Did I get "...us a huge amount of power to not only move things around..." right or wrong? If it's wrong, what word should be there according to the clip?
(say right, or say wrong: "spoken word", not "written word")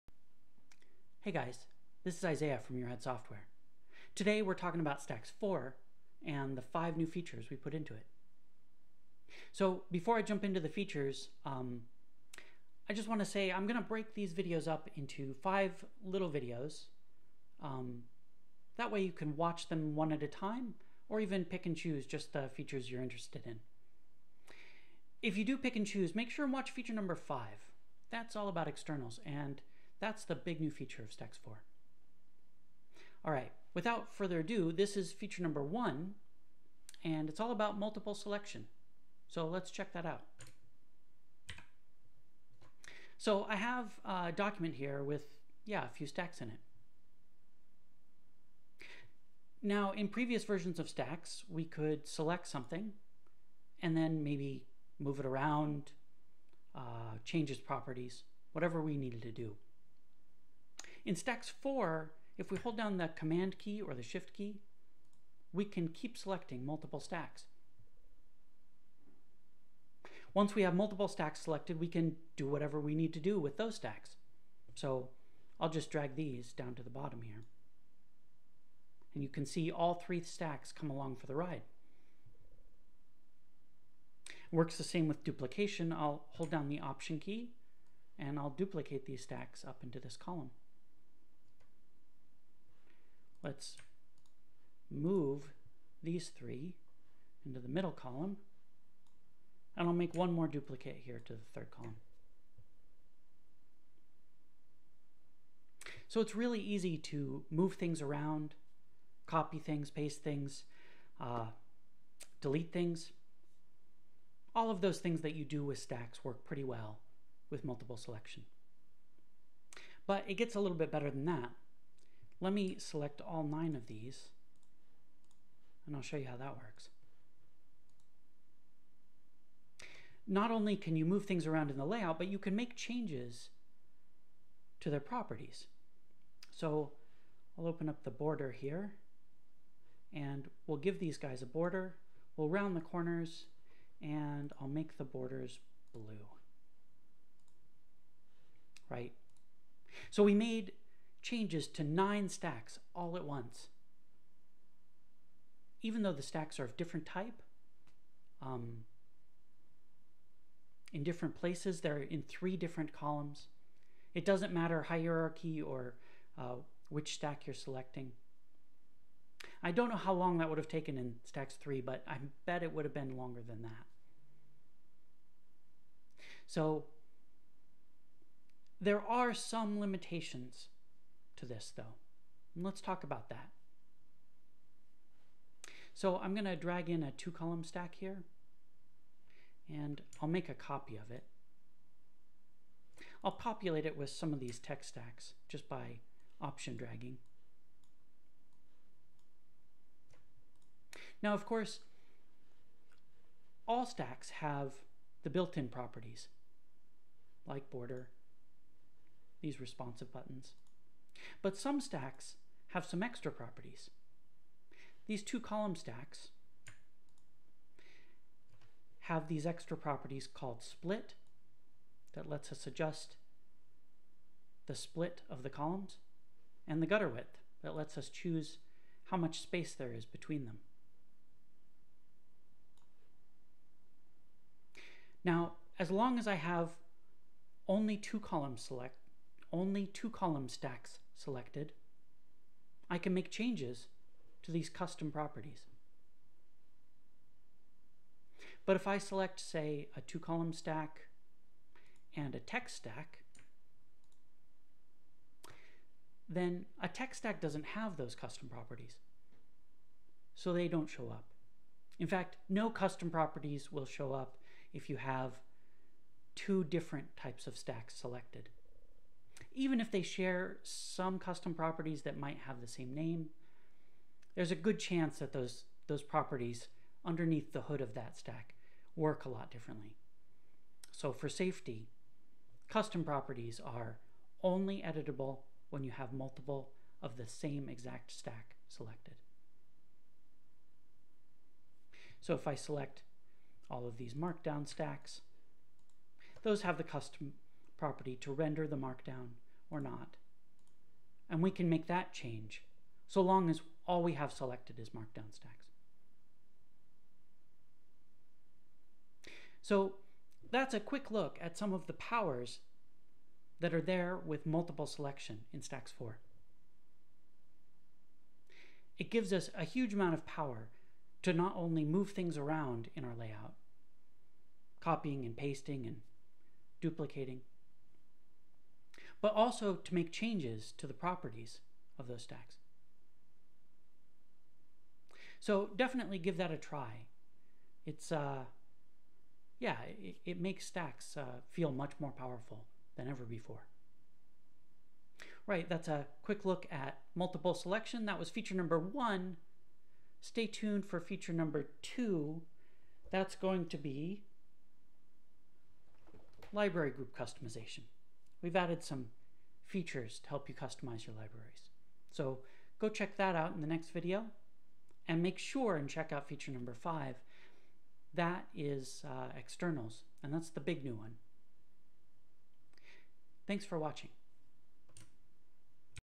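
right.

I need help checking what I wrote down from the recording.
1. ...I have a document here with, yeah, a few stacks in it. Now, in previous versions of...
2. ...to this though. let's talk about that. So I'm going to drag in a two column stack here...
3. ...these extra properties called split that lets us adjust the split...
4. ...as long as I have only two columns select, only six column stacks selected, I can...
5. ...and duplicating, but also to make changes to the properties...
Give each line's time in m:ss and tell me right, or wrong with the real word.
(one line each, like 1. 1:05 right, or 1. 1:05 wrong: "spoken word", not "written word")
1. 0:43 right
2. 3:01 right
3. 3:39 right
4. 3:55 wrong: "two", not "six"
5. 5:25 right.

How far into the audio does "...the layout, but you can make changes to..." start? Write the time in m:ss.
2:11.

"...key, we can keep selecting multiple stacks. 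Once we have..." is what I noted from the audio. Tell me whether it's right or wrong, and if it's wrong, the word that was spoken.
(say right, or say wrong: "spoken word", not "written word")
right.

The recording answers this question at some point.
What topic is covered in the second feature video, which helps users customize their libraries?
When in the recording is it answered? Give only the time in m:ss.
5:56.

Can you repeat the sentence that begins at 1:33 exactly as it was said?
Let's move these three into the middle column.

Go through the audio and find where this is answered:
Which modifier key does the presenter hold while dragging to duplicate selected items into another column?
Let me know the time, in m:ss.
1:26.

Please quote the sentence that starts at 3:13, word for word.
I'll populate it with some of these text stacks just by option dragging.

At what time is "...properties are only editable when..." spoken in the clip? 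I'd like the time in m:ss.
4:43.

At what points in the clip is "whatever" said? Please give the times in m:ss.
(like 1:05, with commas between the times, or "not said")
0:58, 1:12.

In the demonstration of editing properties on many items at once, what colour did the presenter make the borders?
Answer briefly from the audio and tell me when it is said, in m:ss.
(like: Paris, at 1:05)
Blue, at 2:25.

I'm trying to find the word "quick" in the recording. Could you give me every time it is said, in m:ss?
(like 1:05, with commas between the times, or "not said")
5:10, 5:46.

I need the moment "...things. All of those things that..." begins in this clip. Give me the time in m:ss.
1:52.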